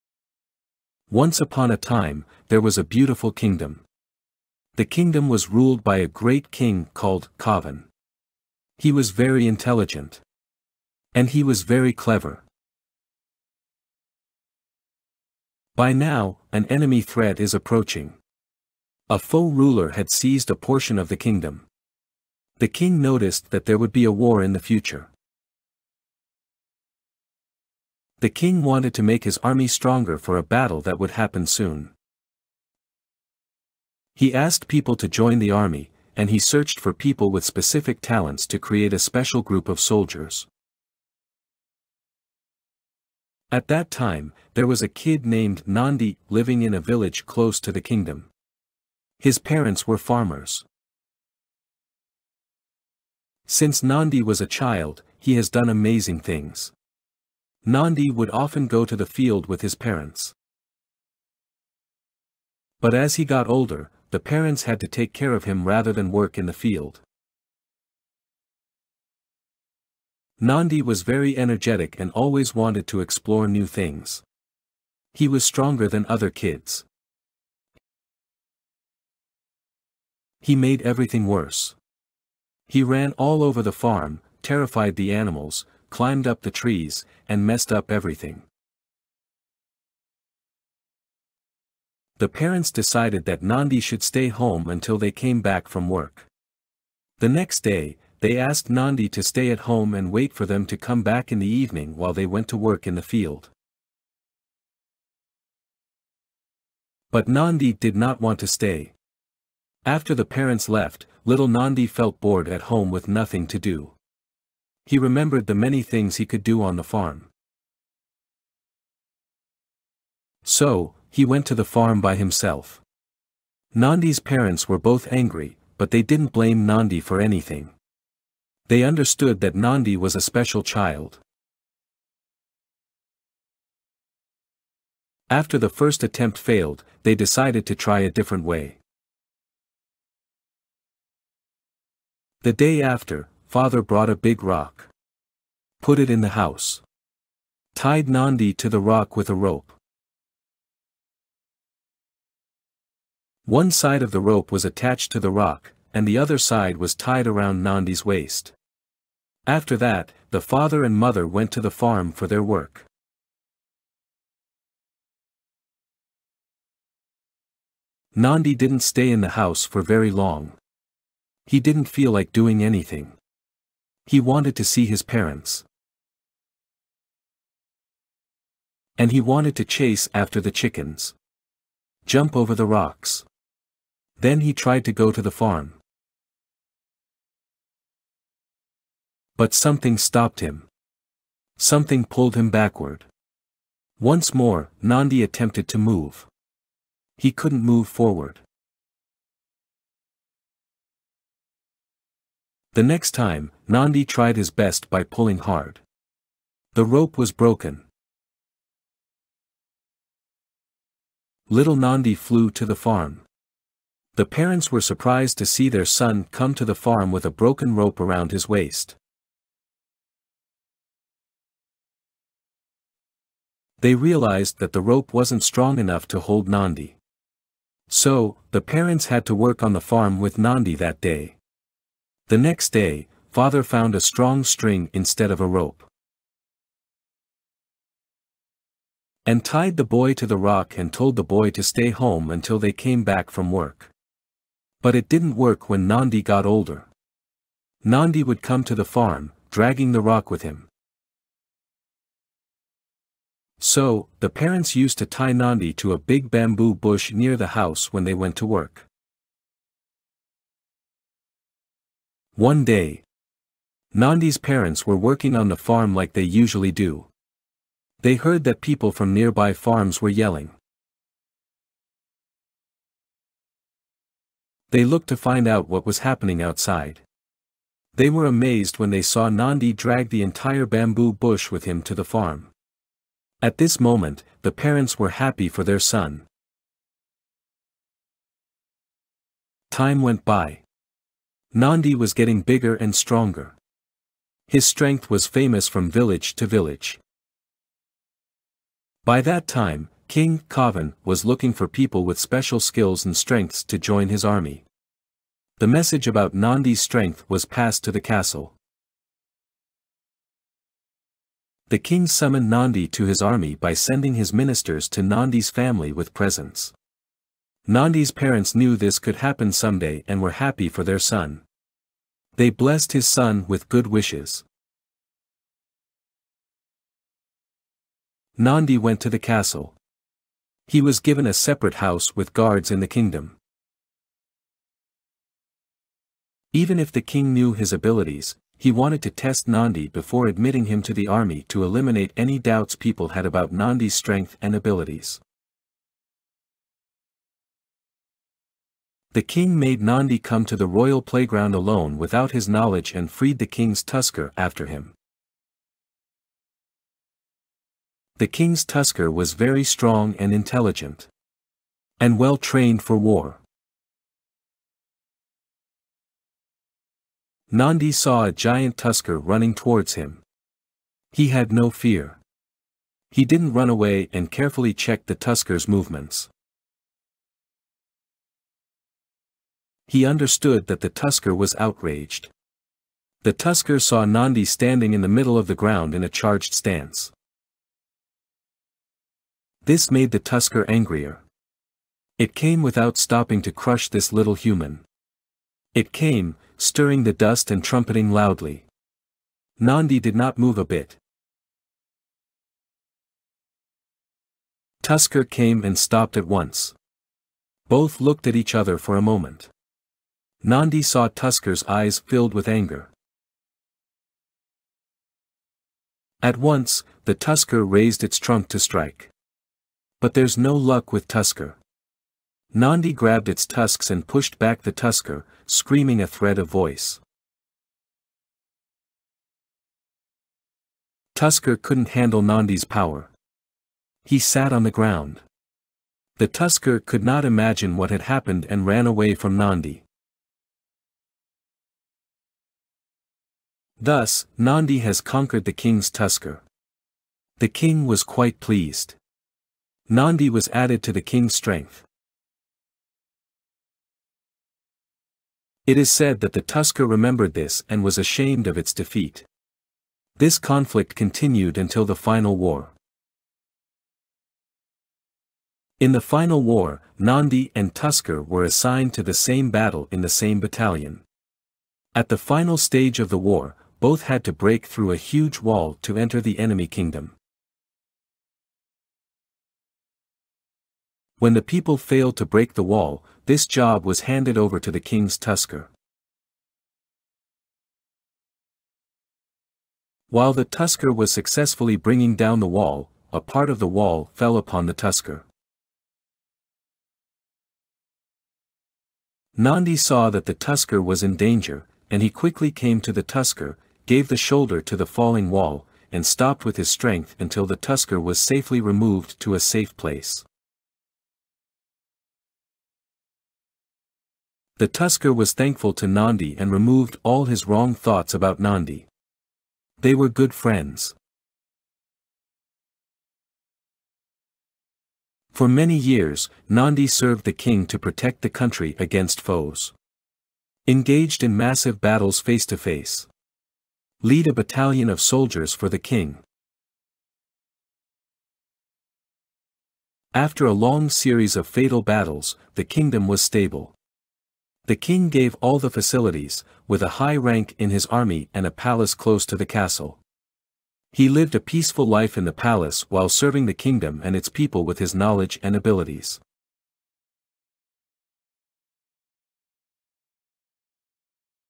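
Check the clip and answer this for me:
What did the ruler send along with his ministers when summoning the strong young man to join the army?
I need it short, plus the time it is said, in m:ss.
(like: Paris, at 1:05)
Presents, at 5:16.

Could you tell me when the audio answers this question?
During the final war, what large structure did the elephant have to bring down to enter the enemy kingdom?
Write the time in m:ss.
7:54.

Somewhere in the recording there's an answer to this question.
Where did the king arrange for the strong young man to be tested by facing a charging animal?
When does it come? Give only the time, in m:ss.
5:50.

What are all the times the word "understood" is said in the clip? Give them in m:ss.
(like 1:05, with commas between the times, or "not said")
2:08, 6:20.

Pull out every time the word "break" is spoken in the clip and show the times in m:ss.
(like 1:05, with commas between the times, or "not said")
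7:54, 8:02.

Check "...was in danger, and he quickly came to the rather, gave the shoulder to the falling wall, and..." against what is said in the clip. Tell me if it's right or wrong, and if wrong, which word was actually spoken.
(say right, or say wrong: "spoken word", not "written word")
wrong: "tusker", not "rather".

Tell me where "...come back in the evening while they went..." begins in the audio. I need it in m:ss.
1:40.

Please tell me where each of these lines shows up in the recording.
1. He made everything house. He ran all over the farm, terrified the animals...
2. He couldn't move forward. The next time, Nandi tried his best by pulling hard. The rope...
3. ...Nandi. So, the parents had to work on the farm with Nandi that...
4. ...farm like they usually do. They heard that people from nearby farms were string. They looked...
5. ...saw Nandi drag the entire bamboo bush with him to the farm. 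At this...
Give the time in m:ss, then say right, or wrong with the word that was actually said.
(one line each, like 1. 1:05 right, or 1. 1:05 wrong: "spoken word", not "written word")
1. 1:20 wrong: "worse", not "house"
2. 3:17 right
3. 3:46 right
4. 4:25 wrong: "yelling", not "string"
5. 4:39 right.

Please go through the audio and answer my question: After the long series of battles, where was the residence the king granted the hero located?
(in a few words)
Close to the castle.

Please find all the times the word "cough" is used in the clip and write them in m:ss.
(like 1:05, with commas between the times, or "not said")
not said.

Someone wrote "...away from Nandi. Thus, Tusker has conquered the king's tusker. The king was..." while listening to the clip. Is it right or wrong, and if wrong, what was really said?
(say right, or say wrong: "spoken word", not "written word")
wrong: "Nandi", not "Tusker".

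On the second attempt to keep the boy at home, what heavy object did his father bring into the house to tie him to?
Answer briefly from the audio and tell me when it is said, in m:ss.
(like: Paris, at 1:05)
A big rock, at 2:24.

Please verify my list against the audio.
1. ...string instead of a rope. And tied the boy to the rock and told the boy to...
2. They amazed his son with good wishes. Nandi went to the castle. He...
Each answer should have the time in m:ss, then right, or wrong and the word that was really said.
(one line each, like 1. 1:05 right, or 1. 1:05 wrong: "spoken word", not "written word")
1. 3:54 right
2. 5:22 wrong: "blessed", not "amazed".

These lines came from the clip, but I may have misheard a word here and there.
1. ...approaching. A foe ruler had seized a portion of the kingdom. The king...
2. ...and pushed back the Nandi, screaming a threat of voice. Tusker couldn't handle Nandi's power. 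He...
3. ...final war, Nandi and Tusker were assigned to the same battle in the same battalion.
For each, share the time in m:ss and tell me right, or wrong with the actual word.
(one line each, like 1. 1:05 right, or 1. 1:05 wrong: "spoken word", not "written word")
1. 0:17 right
2. 7:03 wrong: "Tusker", not "Nandi"
3. 7:46 right.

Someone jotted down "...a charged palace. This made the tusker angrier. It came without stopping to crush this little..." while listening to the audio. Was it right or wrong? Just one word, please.
wrong.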